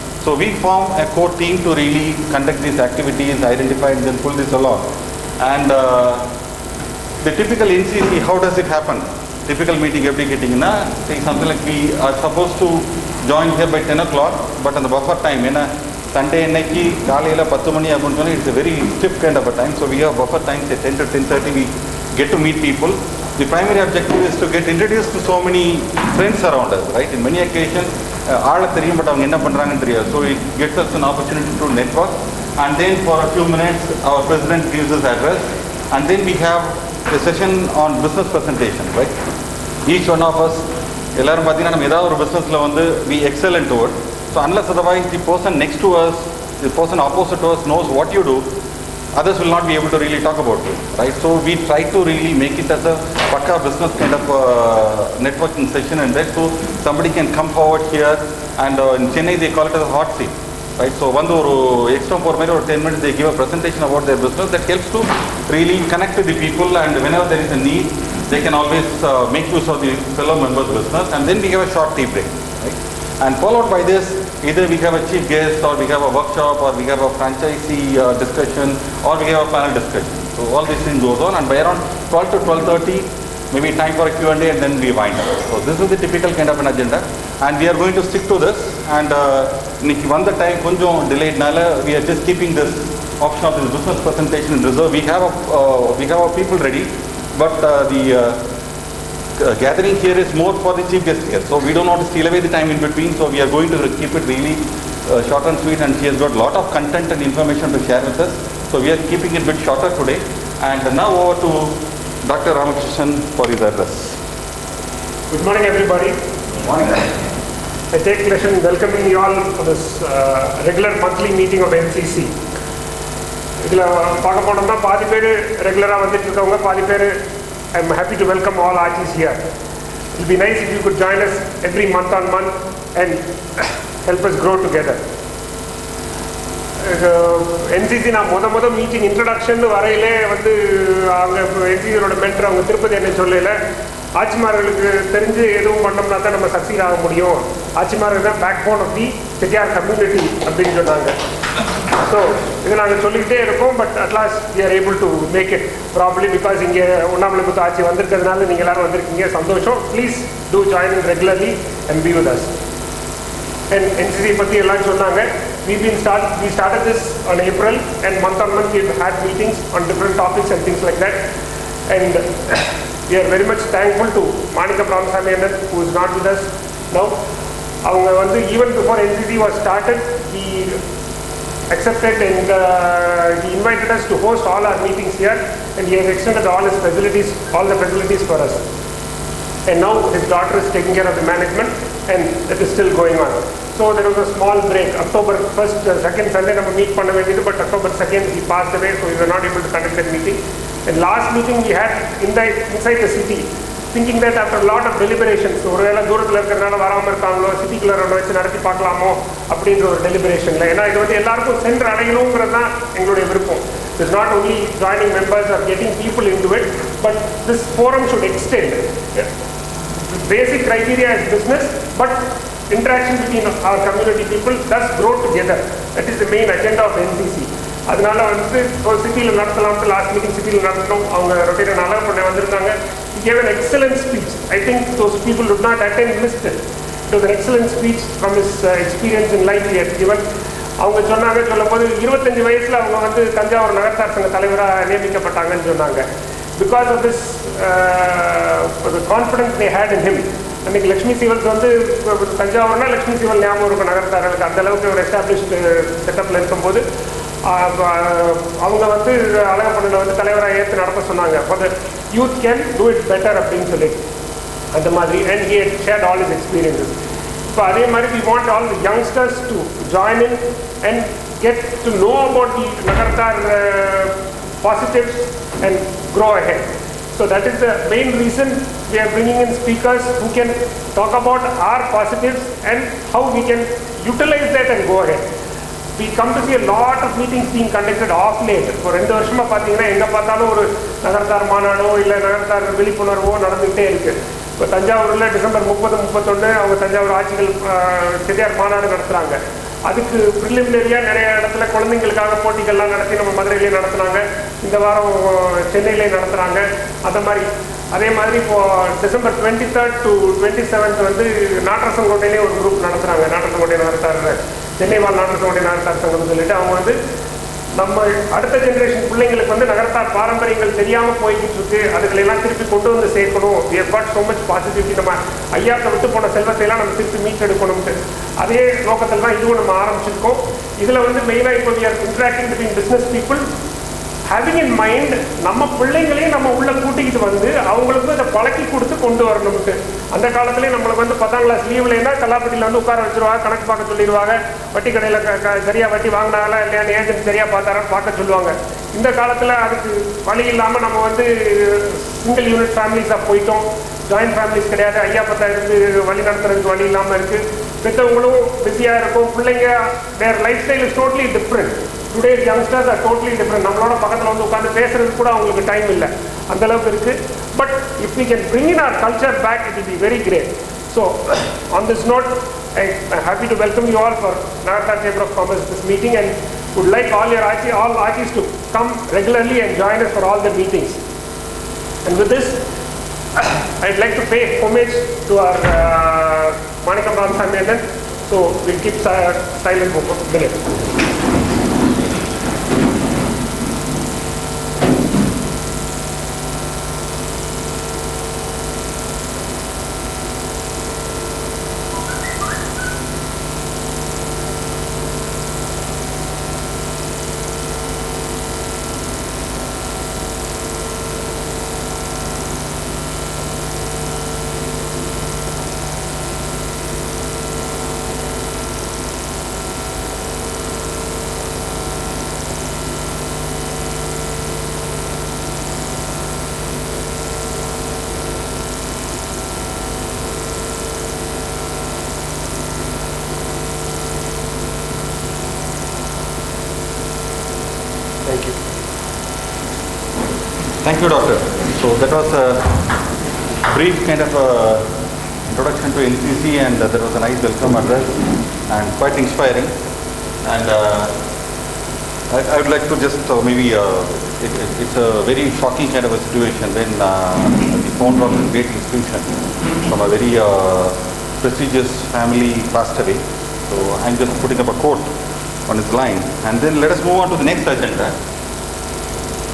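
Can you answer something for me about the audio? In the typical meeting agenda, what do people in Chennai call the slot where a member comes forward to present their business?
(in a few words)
hot seat.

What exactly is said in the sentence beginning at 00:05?
And uh, the typical NCC, how does it happen?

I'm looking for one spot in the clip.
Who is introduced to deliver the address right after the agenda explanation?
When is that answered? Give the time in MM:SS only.
01:52.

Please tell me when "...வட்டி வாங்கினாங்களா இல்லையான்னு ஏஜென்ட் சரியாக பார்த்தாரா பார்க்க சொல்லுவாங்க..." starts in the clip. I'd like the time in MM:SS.
05:45.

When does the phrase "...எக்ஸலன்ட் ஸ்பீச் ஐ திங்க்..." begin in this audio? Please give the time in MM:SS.
03:53.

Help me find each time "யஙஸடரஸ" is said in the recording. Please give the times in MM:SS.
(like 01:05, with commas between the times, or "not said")
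04:28, 06:02.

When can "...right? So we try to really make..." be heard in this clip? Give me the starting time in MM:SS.
00:50.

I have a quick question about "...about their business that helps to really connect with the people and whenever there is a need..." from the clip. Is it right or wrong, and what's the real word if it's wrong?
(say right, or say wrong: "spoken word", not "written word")
right.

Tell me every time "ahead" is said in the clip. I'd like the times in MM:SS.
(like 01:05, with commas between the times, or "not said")
04:36, 04:45.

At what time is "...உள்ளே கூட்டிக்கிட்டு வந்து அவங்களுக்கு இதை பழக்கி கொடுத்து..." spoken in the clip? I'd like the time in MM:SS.
05:36.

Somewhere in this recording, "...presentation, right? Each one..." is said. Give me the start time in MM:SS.
00:38.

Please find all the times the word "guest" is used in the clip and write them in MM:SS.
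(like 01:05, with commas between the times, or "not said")
01:15, 01:41.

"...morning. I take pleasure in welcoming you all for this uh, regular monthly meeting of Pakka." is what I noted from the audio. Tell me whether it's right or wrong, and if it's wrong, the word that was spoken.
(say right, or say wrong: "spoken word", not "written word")
wrong: "NCC", not "Pakka".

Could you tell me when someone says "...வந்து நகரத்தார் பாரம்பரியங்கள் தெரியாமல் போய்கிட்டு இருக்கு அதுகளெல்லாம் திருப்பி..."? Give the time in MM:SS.
05:19.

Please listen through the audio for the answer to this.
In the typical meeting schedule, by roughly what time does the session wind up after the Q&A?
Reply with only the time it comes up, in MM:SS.
01:22.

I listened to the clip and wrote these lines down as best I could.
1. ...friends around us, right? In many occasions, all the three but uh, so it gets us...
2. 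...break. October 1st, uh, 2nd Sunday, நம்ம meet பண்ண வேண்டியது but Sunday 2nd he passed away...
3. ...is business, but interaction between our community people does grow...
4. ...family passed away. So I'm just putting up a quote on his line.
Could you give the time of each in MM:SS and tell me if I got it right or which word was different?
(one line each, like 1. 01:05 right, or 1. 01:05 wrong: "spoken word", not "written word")
1. 00:26 right
2. 03:14 wrong: "October", not "Sunday"
3. 03:41 right
4. 07:42 right.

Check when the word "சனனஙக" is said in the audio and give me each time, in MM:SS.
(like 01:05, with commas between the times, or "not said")
02:30, 02:44, 04:01, 04:05, 04:21.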